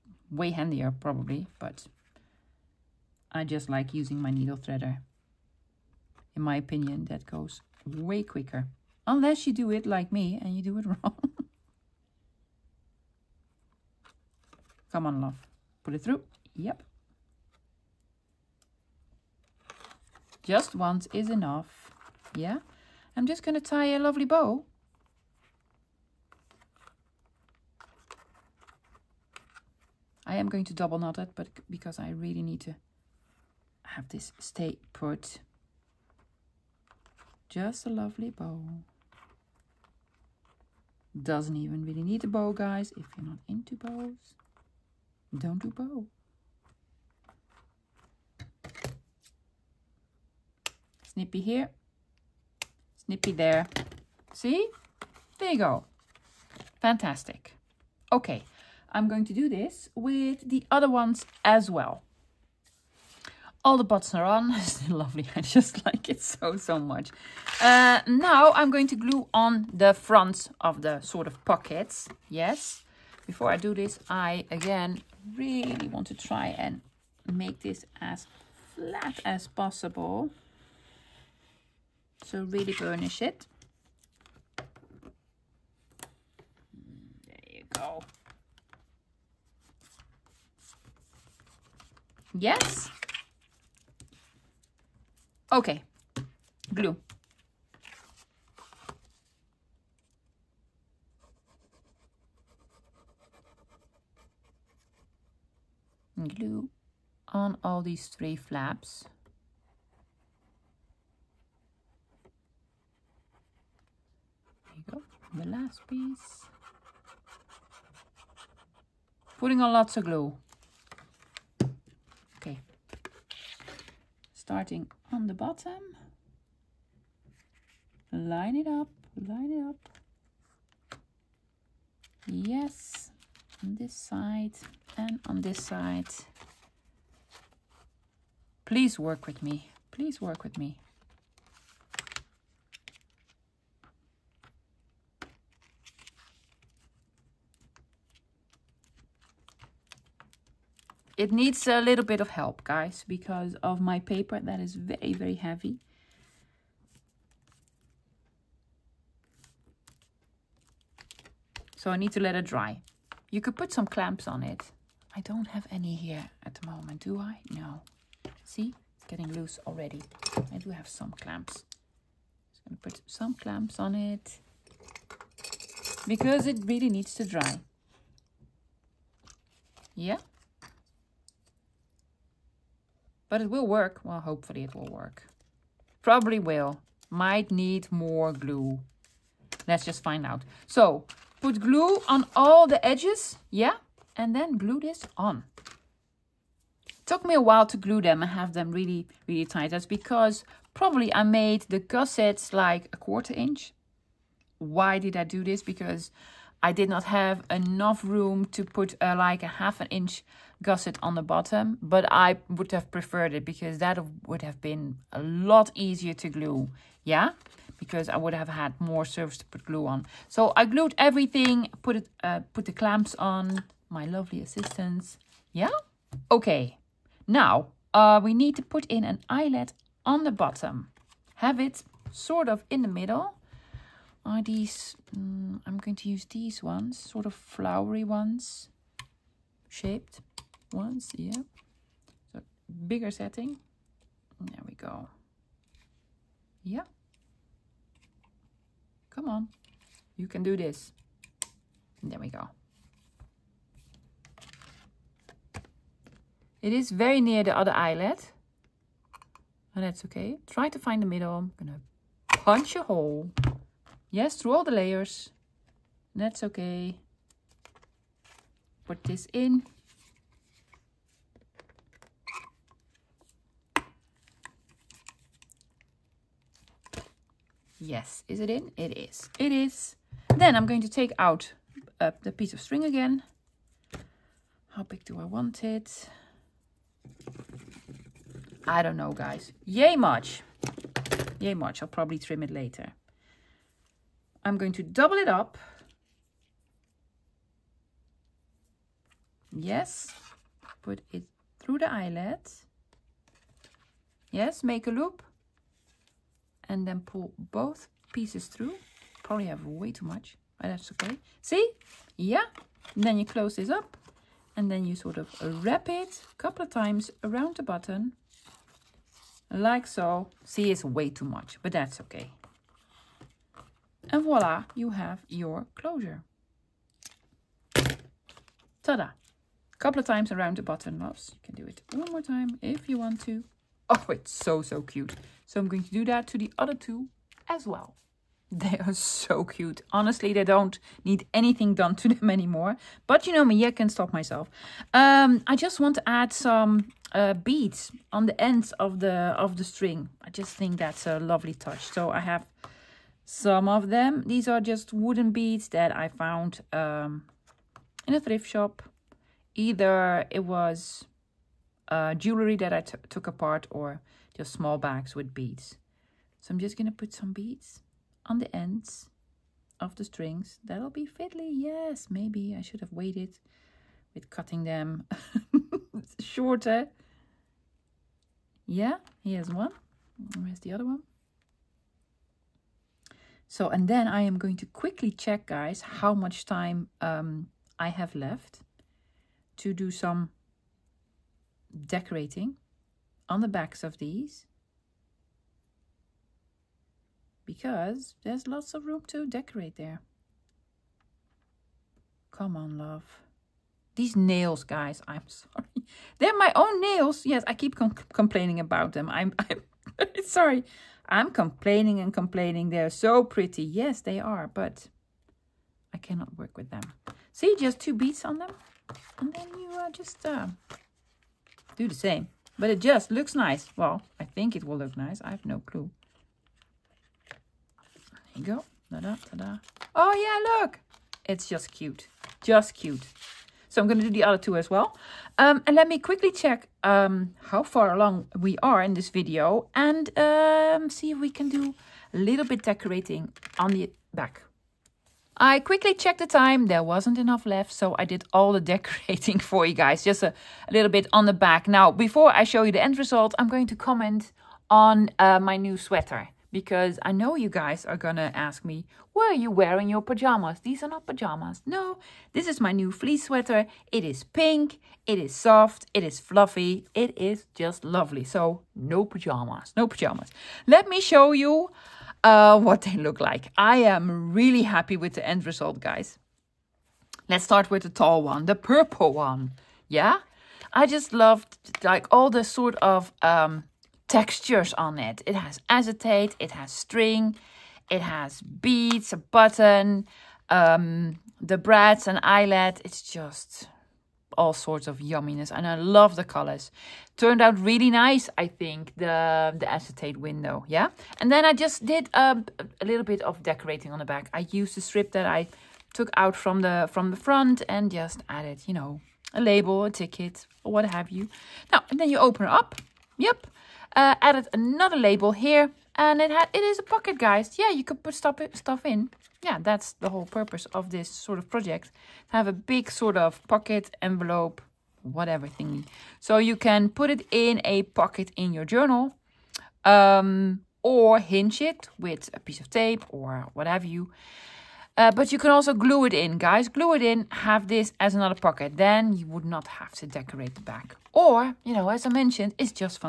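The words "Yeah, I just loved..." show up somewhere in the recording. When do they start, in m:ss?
7:59.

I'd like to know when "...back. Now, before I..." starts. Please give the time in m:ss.
7:31.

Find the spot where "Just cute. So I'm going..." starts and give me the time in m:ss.
7:12.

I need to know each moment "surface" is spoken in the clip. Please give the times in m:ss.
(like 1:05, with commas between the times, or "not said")
3:39.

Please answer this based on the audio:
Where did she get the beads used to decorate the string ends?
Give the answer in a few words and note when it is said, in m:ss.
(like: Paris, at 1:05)
a thrift shop, at 5:58.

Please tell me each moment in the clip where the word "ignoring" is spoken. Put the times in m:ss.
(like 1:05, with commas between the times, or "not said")
not said.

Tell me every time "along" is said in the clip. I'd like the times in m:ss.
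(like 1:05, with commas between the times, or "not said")
7:17.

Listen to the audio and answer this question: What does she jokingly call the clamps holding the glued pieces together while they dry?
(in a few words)
my lovely assistants.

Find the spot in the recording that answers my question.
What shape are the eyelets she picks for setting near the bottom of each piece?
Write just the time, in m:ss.
3:57.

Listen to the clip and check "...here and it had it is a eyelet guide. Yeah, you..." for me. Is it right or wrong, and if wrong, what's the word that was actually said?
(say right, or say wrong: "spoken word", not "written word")
wrong: "pocket", not "eyelet".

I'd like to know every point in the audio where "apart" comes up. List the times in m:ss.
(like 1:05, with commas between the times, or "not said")
6:03.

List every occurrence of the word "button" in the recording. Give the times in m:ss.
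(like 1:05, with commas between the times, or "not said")
1:03, 5:17, 5:30, 8:09.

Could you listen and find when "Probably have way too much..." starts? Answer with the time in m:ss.
5:09.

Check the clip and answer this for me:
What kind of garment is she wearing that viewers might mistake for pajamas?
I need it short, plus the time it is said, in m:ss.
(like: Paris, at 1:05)
fleece sweater, at 7:42.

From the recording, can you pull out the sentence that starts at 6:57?
See, just two beads on them.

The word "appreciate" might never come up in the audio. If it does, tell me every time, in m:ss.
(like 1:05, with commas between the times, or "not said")
not said.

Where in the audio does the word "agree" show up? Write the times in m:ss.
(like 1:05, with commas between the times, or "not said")
not said.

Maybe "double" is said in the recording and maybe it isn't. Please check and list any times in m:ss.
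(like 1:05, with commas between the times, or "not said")
0:30, 4:54.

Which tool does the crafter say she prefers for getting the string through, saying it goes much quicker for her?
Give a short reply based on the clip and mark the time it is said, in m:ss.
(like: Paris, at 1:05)
needle threader, at 0:04.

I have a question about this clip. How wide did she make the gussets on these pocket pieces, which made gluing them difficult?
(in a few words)
a quarter inch.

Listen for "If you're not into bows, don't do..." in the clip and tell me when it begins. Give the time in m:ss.
0:42.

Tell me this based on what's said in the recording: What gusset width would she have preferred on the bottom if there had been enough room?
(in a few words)
half an inch.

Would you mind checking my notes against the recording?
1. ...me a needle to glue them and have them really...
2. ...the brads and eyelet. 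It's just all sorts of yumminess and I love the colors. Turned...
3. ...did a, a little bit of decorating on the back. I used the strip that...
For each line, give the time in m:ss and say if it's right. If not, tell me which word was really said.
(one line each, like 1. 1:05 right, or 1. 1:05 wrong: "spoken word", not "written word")
1. 3:17 wrong: "while", not "needle"
2. 8:11 right
3. 8:21 right.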